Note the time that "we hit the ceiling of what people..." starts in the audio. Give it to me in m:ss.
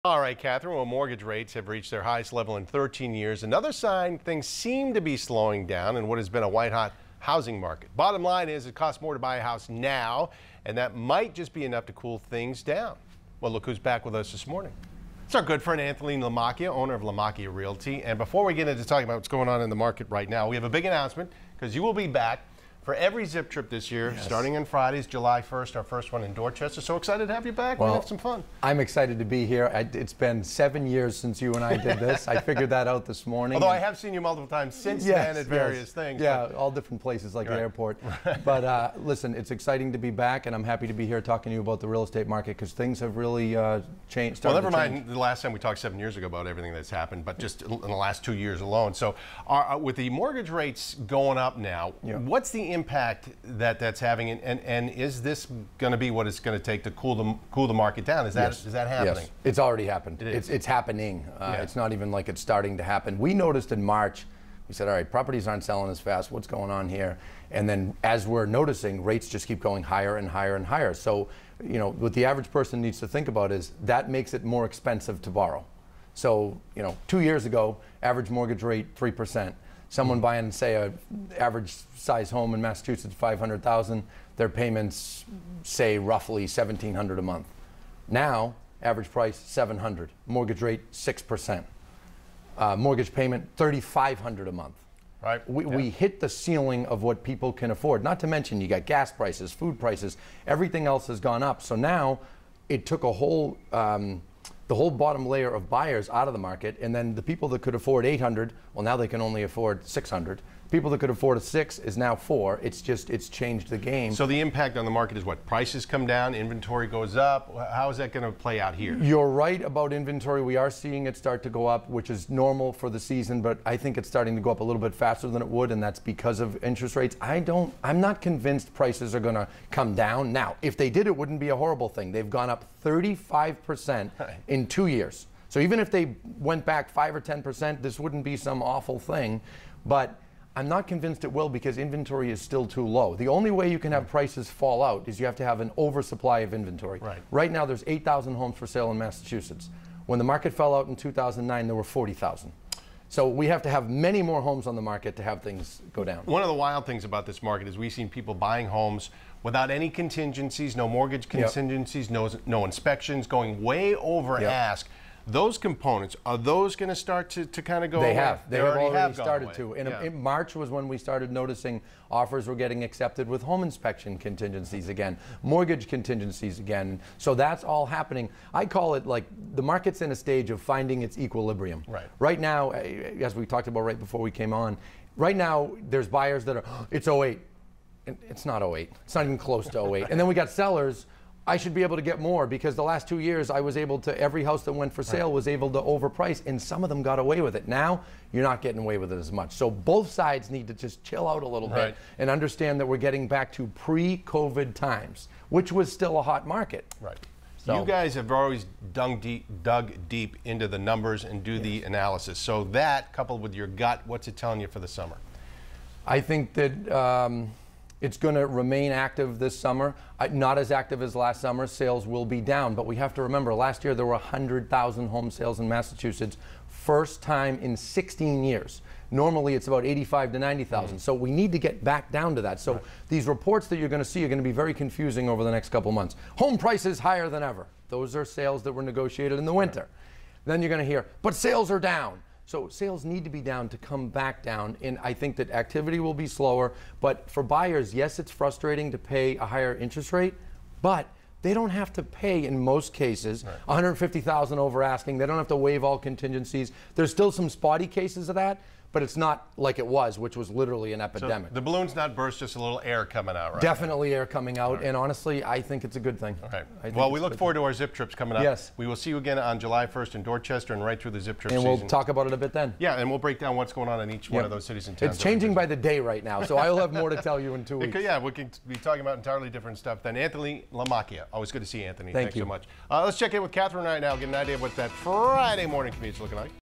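1:35.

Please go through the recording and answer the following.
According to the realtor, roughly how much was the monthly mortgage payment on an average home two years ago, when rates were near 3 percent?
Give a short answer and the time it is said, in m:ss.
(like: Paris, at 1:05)
1,700 a month, at 1:26.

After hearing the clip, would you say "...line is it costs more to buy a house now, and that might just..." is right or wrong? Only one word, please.
right.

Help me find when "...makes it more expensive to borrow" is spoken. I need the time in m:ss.
1:14.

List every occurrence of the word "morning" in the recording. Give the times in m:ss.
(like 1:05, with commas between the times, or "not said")
0:14, 0:33, 4:45.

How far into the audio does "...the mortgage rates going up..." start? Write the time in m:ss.
0:49.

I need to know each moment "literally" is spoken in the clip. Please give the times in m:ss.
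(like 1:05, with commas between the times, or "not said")
4:20.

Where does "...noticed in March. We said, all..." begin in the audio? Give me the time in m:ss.
1:03.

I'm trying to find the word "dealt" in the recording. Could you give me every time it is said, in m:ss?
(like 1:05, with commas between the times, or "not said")
not said.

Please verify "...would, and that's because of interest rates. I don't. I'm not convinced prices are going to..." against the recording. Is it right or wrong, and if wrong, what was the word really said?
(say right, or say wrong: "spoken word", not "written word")
right.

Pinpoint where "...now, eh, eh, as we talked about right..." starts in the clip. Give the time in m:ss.
3:02.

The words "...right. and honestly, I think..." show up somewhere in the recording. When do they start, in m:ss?
4:24.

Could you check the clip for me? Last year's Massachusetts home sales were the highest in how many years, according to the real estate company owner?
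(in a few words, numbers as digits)
16 years.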